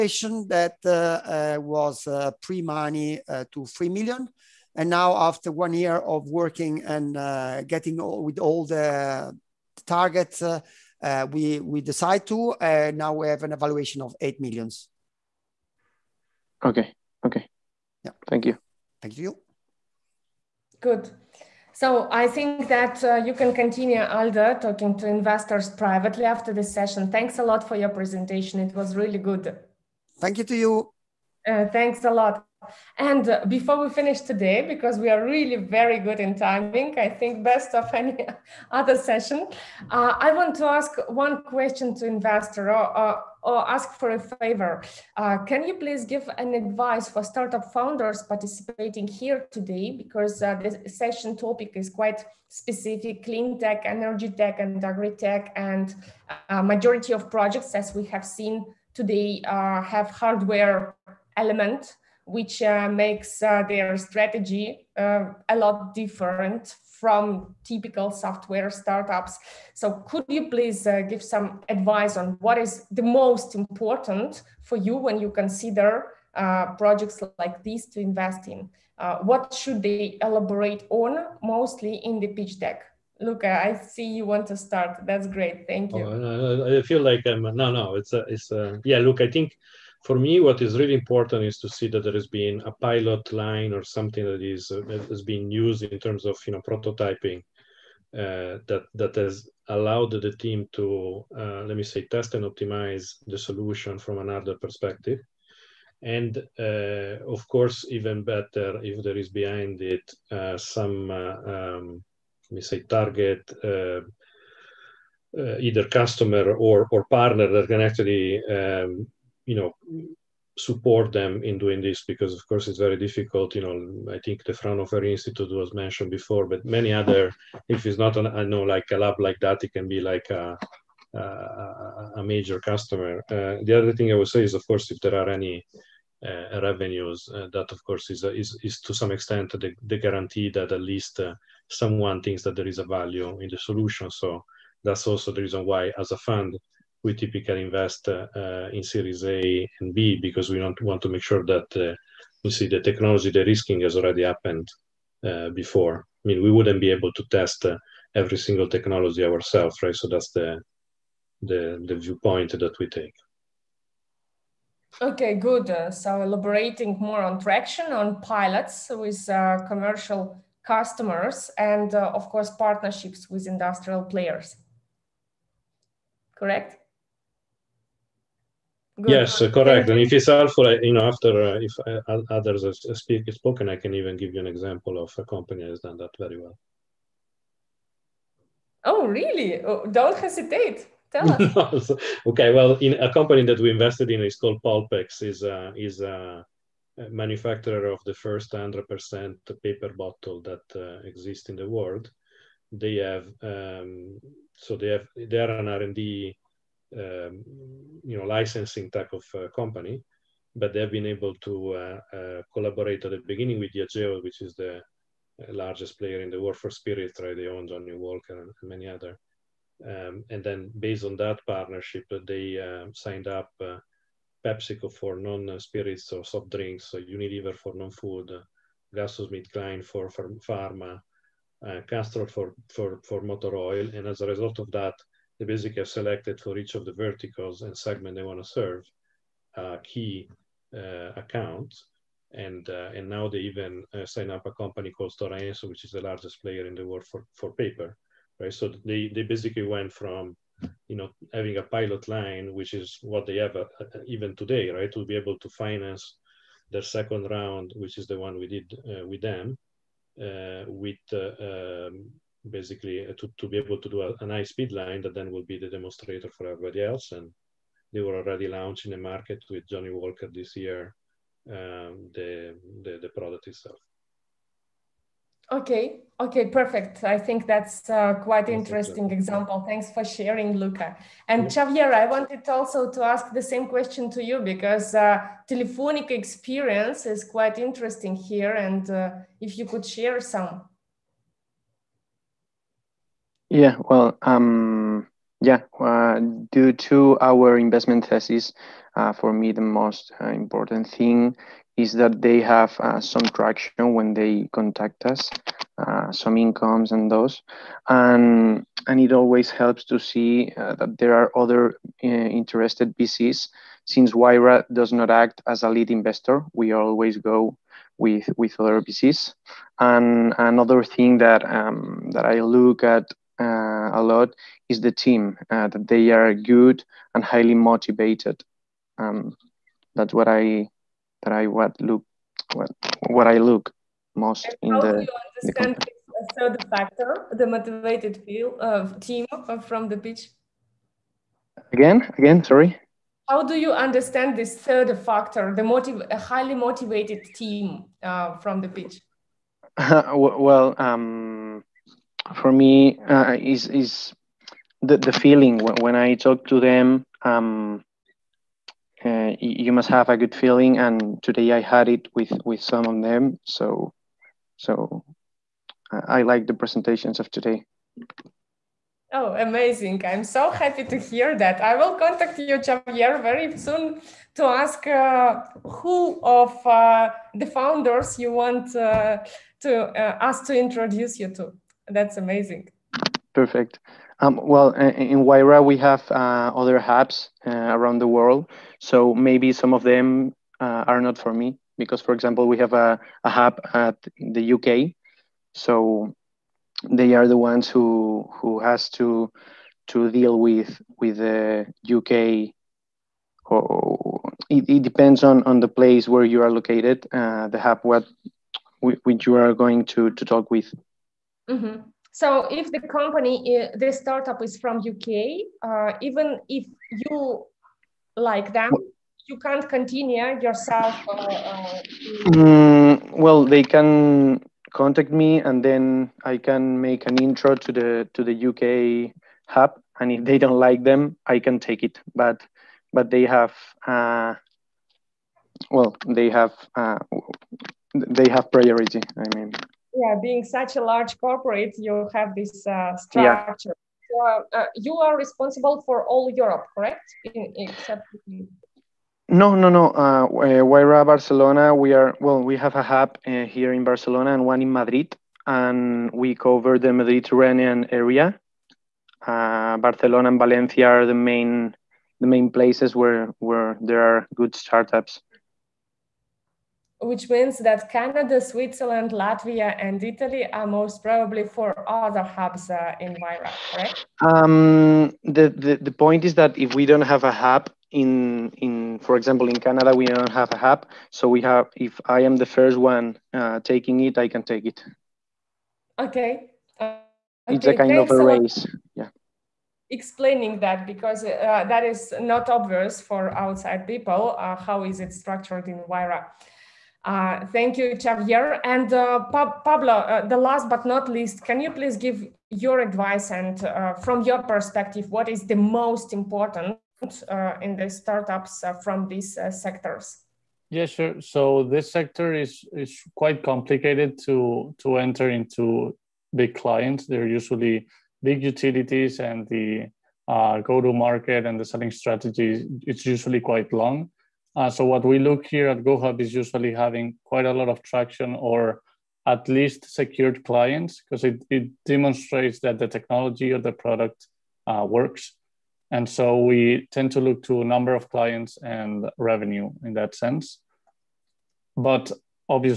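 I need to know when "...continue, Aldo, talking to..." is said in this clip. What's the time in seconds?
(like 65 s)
23 s.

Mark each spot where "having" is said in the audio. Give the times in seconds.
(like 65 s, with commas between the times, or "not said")
251 s, 526 s.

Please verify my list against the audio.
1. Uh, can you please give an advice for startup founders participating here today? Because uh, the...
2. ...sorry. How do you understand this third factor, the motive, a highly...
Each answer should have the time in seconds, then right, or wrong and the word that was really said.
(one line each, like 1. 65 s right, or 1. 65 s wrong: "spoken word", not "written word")
1. 45 s right
2. 342 s right.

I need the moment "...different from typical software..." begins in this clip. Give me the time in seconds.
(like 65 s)
65 s.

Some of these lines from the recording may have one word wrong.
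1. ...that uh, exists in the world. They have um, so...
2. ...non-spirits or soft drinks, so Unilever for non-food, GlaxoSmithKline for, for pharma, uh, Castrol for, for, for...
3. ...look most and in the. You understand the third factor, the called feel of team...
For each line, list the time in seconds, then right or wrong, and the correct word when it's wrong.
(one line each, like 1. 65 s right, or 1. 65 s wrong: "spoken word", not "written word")
1. 200 s right
2. 225 s right
3. 333 s wrong: "motivated", not "called".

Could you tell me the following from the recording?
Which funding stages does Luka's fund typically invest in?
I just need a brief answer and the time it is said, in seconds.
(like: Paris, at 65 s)
Series A and B, at 148 s.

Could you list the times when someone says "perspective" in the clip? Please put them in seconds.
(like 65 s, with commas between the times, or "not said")
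104 s, 504 s.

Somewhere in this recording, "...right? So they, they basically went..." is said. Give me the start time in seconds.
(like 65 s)
248 s.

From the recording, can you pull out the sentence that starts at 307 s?
And, and it always helps to see uh, that there are other interested VCs.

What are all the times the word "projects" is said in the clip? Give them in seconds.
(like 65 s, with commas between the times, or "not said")
57 s, 76 s.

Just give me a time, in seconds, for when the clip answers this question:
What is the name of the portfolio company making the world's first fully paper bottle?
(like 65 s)
194 s.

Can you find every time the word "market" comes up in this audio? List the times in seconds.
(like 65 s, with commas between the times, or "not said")
269 s, 520 s.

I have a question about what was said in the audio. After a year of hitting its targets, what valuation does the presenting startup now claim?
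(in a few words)
8 million.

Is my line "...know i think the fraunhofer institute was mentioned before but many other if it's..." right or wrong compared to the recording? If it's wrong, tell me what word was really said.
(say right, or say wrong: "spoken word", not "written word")
right.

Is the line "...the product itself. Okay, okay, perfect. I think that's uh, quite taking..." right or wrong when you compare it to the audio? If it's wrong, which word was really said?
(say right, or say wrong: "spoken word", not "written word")
wrong: "interesting", not "taking".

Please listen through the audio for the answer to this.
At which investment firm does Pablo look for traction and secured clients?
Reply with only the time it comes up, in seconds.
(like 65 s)
525 s.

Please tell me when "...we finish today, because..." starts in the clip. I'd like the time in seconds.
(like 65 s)
33 s.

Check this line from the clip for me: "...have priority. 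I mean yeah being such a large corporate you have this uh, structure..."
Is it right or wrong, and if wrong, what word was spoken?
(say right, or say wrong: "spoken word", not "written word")
right.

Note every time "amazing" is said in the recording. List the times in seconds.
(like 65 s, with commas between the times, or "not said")
369 s, 382 s.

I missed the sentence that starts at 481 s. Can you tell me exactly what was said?
So we have, if I am the first one uh, taking it, I can take it.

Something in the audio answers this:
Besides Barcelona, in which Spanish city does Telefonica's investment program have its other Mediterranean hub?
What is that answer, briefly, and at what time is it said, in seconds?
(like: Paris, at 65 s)
Madrid, at 454 s.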